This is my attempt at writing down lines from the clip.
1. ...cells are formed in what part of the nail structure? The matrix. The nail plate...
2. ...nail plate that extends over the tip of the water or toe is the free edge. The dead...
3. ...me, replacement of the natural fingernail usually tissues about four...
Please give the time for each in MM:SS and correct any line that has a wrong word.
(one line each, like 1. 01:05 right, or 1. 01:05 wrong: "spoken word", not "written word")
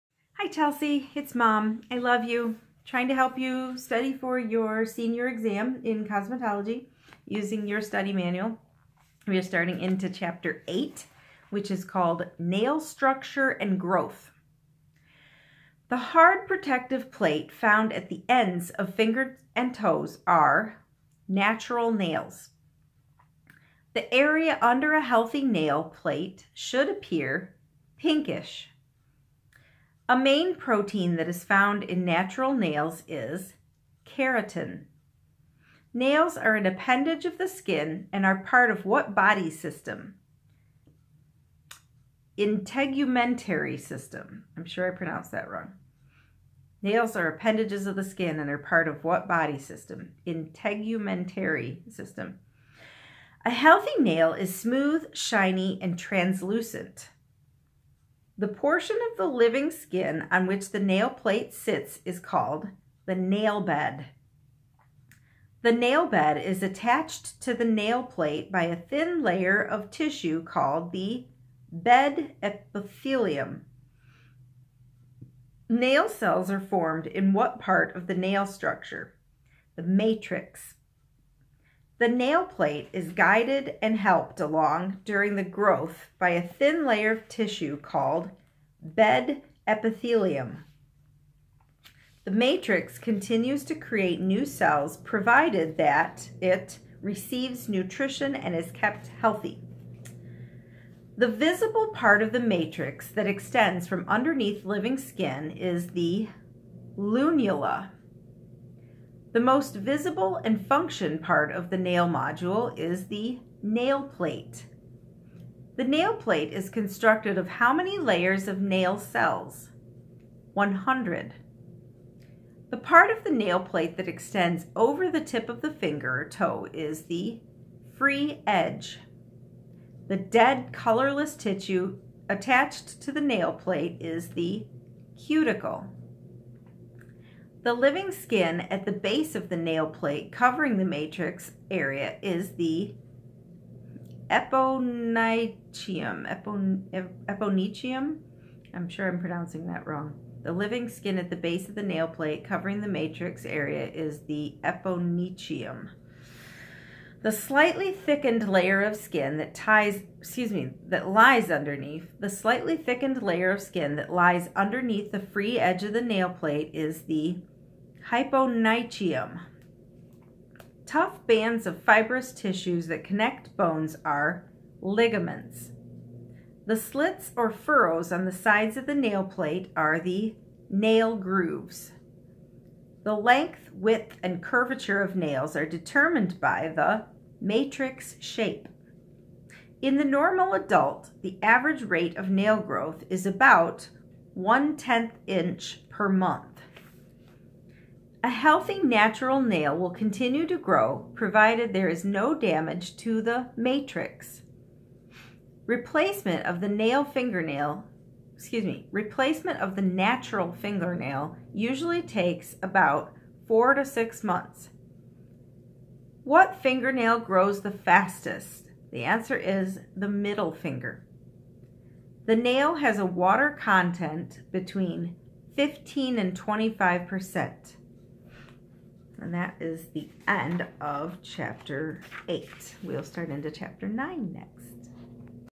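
1. 01:16 right
2. 02:03 wrong: "finger", not "water"
3. 03:28 wrong: "takes", not "tissues".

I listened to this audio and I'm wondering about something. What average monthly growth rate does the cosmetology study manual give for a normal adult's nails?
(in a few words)
1/10 inch per month.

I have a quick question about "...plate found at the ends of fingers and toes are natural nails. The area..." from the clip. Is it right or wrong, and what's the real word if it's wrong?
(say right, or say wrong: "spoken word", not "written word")
right.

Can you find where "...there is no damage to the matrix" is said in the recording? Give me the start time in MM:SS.
03:21.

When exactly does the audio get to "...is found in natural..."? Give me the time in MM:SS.
00:31.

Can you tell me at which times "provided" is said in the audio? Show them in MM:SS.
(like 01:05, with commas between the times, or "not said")
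01:34, 03:21.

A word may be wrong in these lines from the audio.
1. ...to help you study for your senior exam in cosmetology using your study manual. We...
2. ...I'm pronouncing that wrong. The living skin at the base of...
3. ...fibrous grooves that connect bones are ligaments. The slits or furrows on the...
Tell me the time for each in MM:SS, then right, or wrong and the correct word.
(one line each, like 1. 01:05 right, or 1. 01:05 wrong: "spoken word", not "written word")
1. 00:03 right
2. 02:29 right
3. 02:51 wrong: "tissues", not "grooves".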